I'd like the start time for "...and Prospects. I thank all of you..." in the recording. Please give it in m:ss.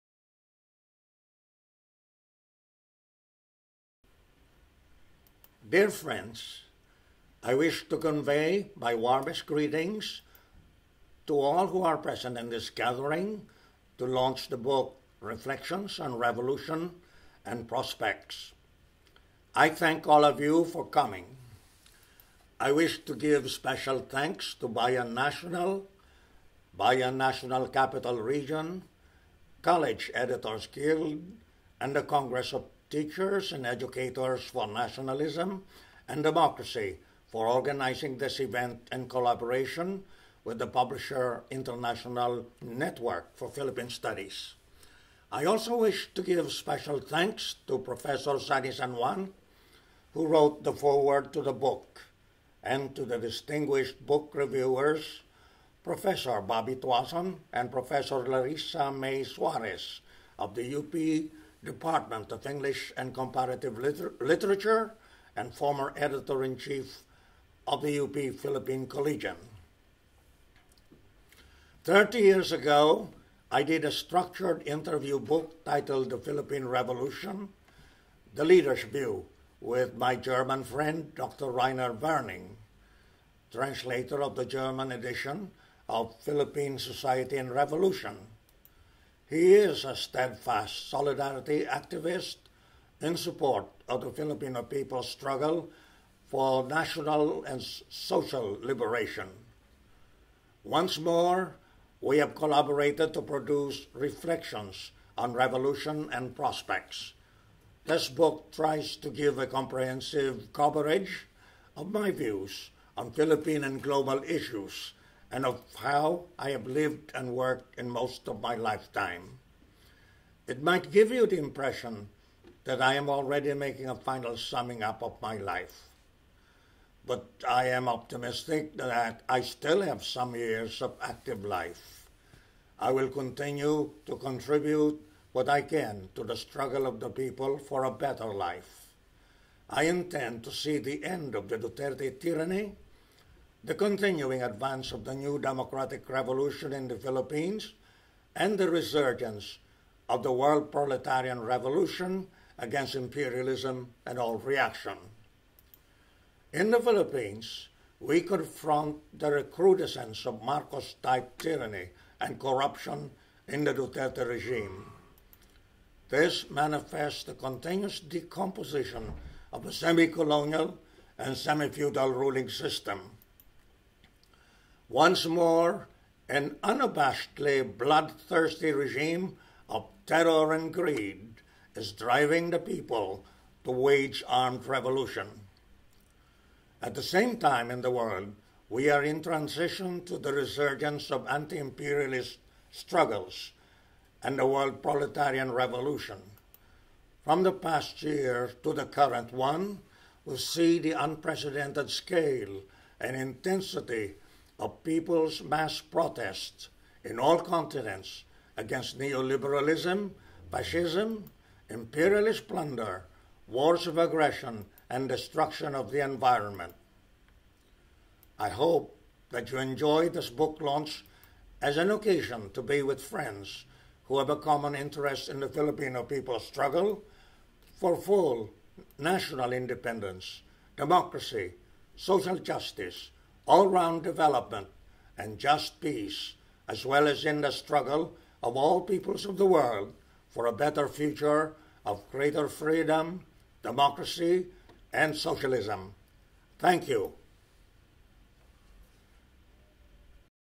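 0:17.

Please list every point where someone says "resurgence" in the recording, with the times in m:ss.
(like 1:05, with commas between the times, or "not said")
2:28, 3:10.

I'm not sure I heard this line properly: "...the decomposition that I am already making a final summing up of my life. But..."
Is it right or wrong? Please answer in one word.
wrong.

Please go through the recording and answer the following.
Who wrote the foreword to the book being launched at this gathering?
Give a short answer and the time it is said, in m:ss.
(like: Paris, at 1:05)
Sani San Juan, at 0:47.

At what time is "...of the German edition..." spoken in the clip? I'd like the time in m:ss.
1:24.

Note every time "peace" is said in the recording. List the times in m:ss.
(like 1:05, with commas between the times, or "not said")
3:55.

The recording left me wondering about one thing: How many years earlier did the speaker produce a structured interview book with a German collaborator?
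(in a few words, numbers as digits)
30.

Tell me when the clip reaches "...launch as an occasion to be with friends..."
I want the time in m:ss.
3:40.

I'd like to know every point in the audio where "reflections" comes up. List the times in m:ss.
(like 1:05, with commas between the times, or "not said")
0:15, 1:43.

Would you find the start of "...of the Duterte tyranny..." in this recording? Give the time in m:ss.
2:21.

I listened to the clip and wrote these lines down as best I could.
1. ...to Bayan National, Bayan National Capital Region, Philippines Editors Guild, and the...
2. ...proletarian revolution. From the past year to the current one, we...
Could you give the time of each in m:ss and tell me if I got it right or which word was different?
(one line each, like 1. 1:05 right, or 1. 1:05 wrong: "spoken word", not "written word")
1. 0:24 wrong: "College", not "Philippines"
2. 3:14 right.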